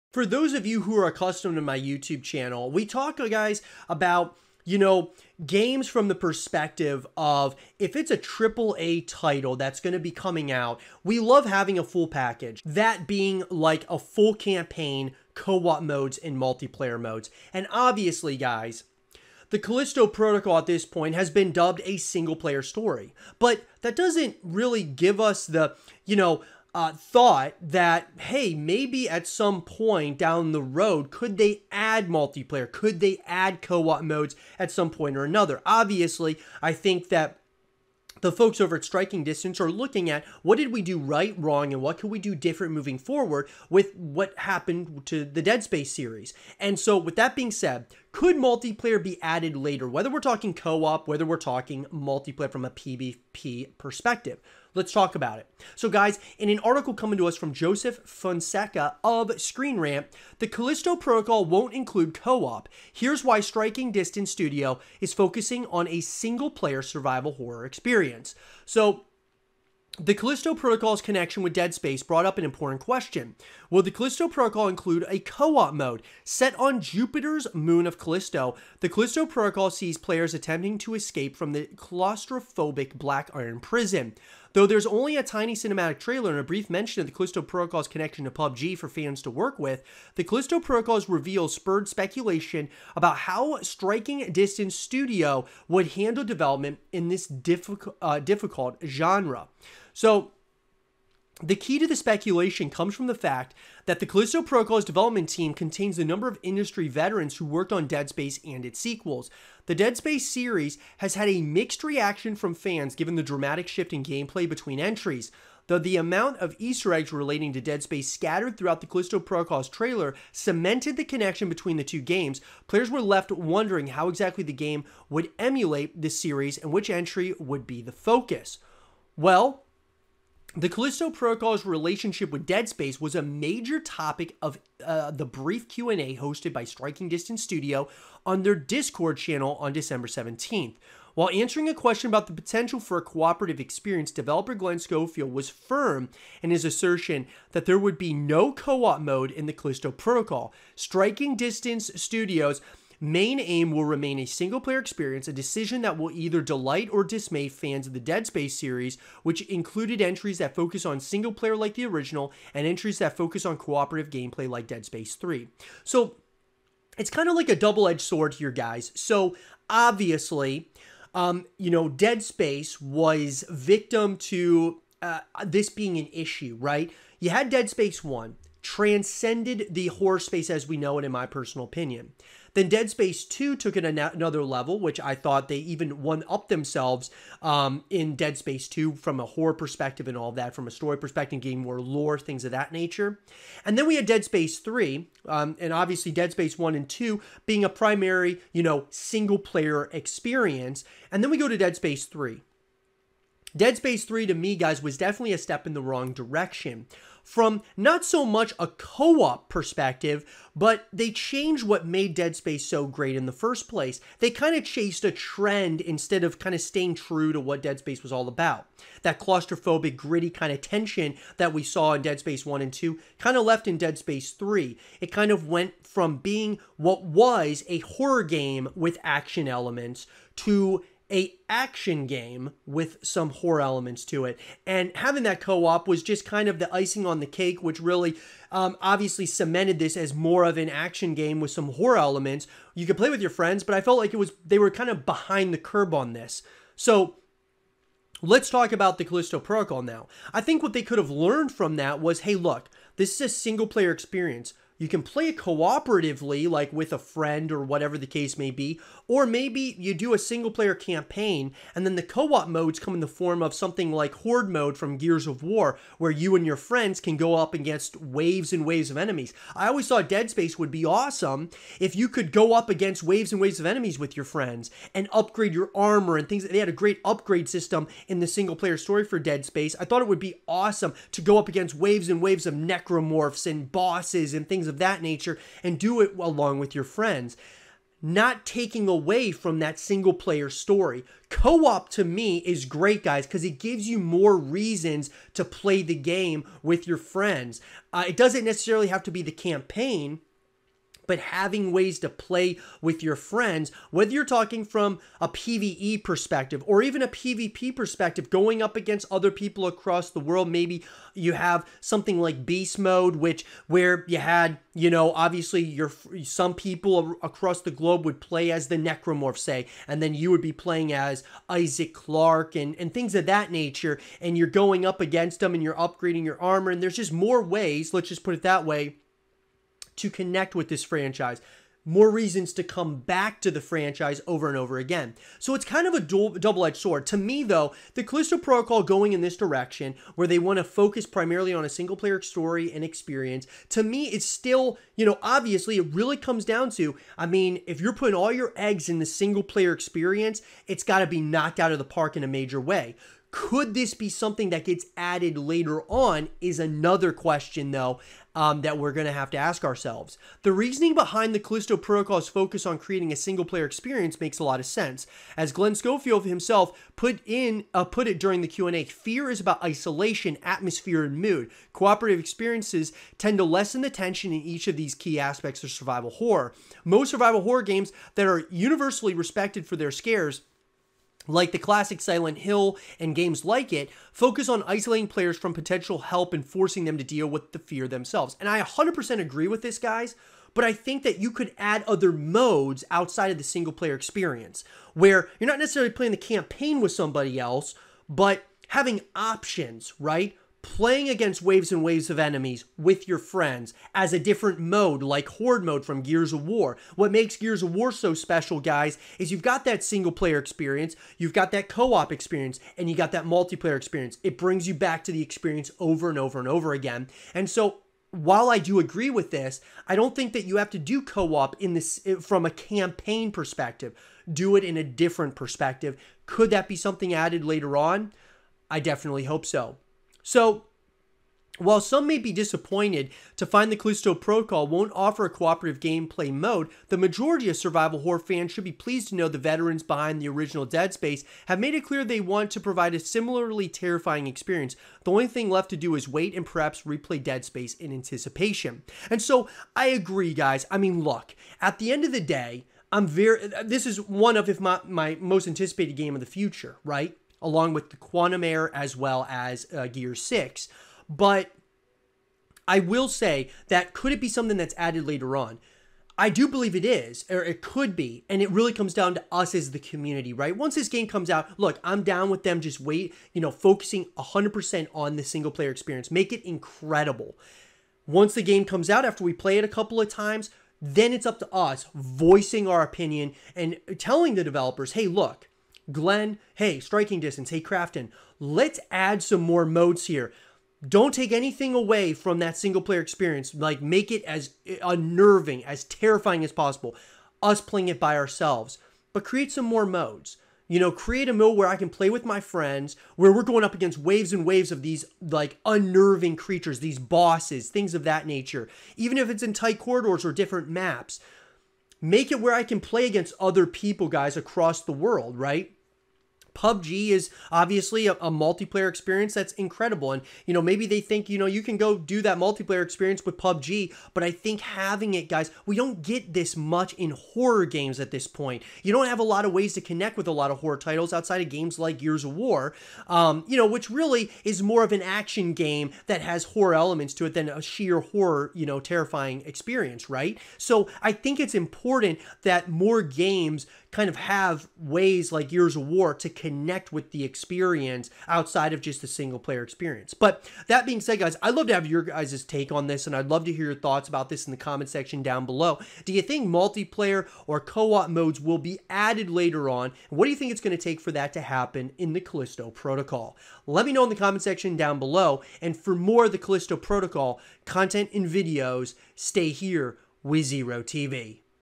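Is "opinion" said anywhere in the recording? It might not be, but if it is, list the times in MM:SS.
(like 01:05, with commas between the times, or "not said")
03:01, 08:02.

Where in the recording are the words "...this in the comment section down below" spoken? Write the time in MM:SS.
09:14.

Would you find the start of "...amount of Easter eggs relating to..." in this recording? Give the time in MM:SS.
01:55.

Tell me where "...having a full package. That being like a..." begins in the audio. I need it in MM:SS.
00:11.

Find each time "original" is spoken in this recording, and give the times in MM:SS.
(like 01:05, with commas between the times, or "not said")
02:41, 07:20.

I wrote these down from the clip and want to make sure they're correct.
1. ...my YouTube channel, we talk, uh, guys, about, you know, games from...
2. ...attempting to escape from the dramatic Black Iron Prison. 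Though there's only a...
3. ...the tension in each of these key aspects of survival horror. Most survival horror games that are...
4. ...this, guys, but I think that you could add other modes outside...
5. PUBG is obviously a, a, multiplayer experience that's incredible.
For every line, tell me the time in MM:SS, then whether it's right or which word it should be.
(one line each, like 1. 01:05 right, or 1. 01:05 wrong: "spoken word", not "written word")
1. 00:01 right
2. 01:20 wrong: "claustrophobic", not "dramatic"
3. 06:13 right
4. 06:29 right
5. 08:36 right.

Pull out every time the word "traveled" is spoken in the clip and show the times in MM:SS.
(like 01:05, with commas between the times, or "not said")
not said.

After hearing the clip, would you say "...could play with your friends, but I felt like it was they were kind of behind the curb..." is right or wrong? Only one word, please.
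right.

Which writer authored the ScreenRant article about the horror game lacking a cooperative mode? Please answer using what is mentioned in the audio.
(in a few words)
Joseph Fonseca.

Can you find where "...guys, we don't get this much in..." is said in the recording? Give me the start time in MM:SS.
08:45.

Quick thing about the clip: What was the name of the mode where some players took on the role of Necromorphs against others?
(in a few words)
Beast Mode.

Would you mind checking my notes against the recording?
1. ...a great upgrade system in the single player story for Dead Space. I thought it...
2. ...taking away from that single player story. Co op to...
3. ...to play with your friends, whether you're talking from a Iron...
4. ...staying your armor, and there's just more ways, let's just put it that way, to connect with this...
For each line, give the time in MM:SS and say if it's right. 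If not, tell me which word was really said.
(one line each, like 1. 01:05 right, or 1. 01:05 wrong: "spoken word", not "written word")
1. 04:36 right
2. 04:48 right
3. 05:01 wrong: "PvE", not "Iron"
4. 05:25 wrong: "upgrading", not "staying".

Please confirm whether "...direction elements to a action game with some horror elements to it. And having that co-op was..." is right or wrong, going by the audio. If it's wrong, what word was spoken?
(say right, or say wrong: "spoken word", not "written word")
wrong: "action", not "direction".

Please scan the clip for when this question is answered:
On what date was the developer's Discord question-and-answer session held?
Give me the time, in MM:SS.
02:19.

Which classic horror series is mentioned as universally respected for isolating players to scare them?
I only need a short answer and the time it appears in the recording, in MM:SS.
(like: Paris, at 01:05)
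Silent Hill, at 06:22.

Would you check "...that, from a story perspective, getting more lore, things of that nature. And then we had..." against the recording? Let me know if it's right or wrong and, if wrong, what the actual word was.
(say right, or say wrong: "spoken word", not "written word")
right.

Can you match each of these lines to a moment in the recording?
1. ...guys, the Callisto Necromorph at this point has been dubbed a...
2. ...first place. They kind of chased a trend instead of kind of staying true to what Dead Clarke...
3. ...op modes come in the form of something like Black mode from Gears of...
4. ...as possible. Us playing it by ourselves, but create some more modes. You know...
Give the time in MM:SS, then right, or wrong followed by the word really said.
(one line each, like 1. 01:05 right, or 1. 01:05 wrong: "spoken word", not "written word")
1. 00:18 wrong: "Protocol", not "Necromorph"
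2. 03:33 wrong: "Space", not "Clarke"
3. 04:22 wrong: "Horde", not "Black"
4. 08:16 right.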